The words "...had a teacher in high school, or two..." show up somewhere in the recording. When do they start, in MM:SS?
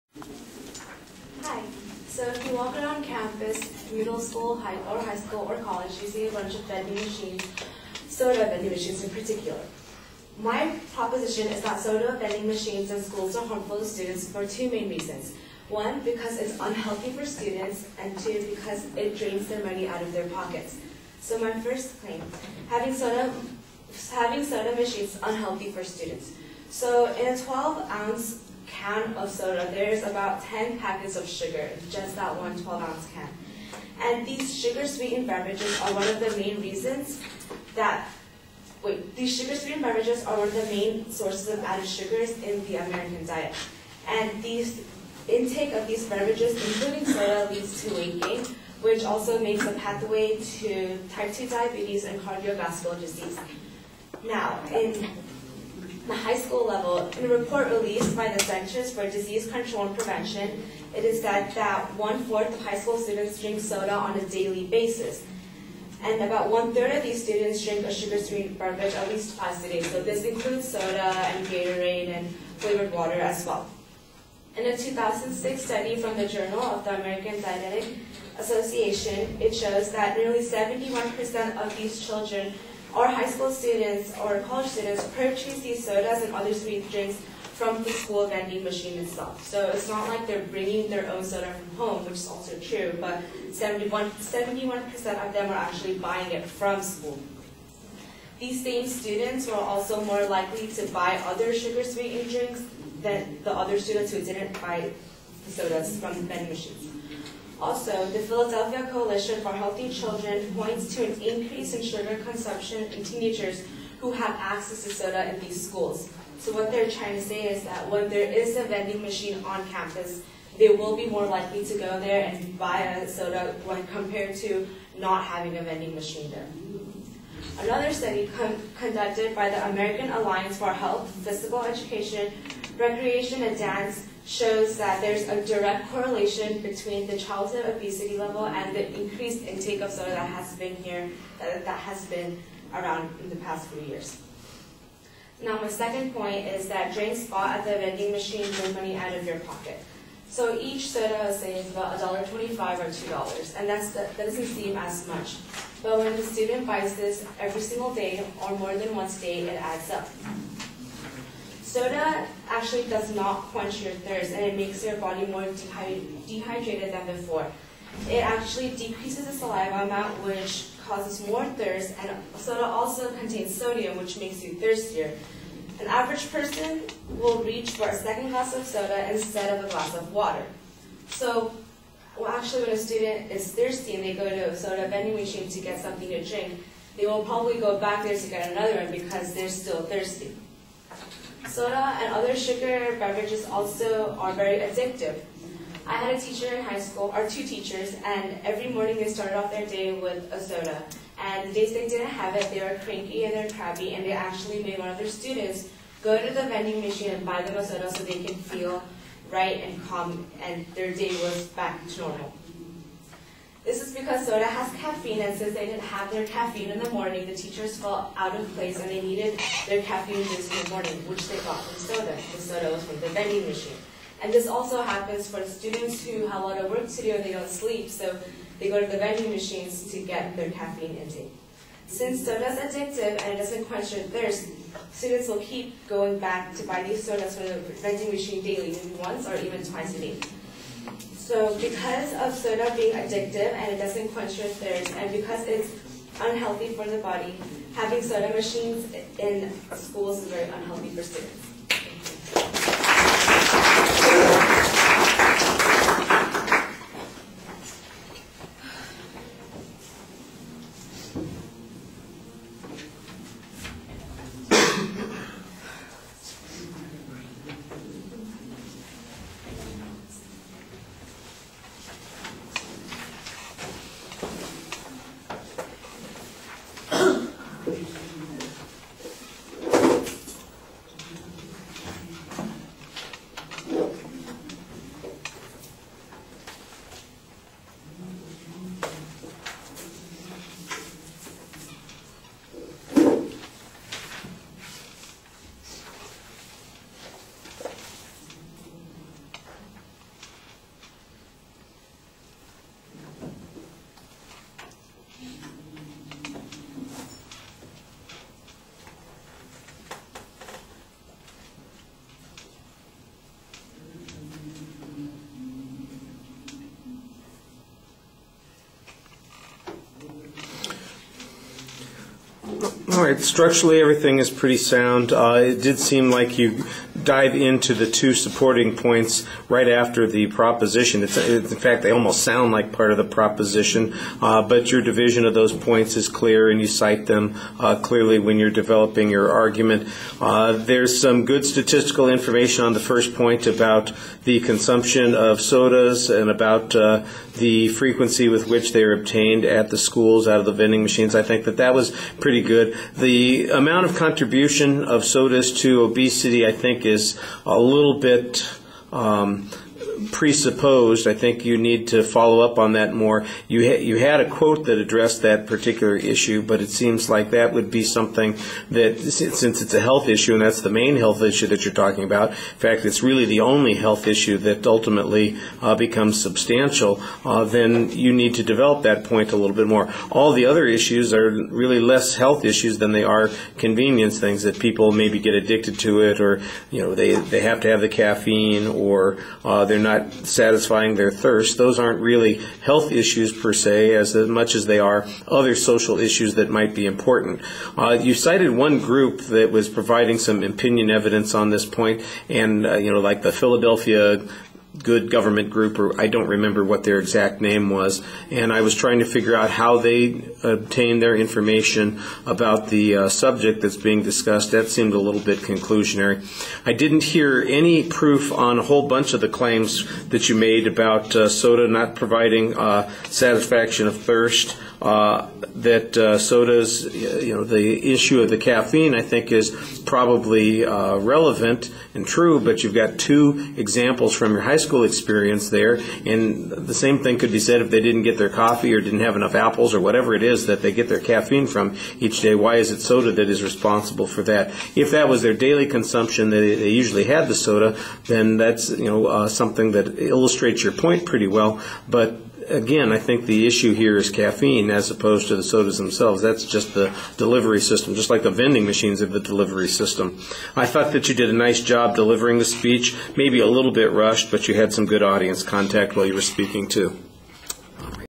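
03:15.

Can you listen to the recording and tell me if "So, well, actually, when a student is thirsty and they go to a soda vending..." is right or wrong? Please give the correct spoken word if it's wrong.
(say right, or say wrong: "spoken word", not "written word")
right.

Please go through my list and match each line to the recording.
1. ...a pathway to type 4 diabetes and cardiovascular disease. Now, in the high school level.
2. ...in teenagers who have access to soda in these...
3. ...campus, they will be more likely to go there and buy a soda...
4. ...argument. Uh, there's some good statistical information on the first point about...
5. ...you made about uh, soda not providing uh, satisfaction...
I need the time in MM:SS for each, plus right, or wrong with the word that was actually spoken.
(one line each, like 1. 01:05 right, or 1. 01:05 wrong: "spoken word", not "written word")
1. 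00:49 wrong: "2", not "4"
2. 01:52 right
3. 01:59 right
4. 05:39 right
5. 07:00 right.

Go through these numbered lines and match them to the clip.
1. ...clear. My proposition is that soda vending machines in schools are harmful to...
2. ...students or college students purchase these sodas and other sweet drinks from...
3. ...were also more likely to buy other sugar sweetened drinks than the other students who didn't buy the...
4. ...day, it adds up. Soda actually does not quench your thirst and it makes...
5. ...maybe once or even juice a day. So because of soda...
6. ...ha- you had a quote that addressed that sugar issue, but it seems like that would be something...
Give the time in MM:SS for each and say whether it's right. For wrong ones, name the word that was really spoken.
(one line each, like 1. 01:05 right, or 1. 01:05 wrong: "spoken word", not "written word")
1. 00:09 wrong: "particular", not "clear"
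2. 01:23 right
3. 01:39 right
4. 02:39 right
5. 03:58 wrong: "twice", not "juice"
6. 06:03 wrong: "particular", not "sugar".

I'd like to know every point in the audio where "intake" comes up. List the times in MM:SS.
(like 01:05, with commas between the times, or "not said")
00:45, 02:19, 03:50.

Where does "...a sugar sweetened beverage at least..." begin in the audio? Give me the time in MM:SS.
01:07.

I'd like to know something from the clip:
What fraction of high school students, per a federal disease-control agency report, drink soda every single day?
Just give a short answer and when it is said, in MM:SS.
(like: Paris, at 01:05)
one-fourth, at 01:01.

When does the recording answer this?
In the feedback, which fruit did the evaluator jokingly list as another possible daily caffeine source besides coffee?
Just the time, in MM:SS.
07:19.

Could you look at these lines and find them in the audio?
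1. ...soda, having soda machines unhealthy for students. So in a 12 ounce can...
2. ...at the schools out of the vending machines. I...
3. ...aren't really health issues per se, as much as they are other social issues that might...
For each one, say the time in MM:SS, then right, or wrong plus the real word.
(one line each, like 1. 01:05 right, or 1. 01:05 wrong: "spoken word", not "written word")
1. 00:22 right
2. 05:49 right
3. 06:31 right.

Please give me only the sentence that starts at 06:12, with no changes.
In fact, it's really the only health issue that ultimately uh, becomes substantial.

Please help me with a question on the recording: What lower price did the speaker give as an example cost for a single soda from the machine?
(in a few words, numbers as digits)
$1.25.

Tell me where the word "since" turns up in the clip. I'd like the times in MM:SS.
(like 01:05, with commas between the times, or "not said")
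03:35, 03:51, 06:08.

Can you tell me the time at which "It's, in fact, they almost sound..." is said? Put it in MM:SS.
05:31.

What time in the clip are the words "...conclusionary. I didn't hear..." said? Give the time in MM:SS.
06:55.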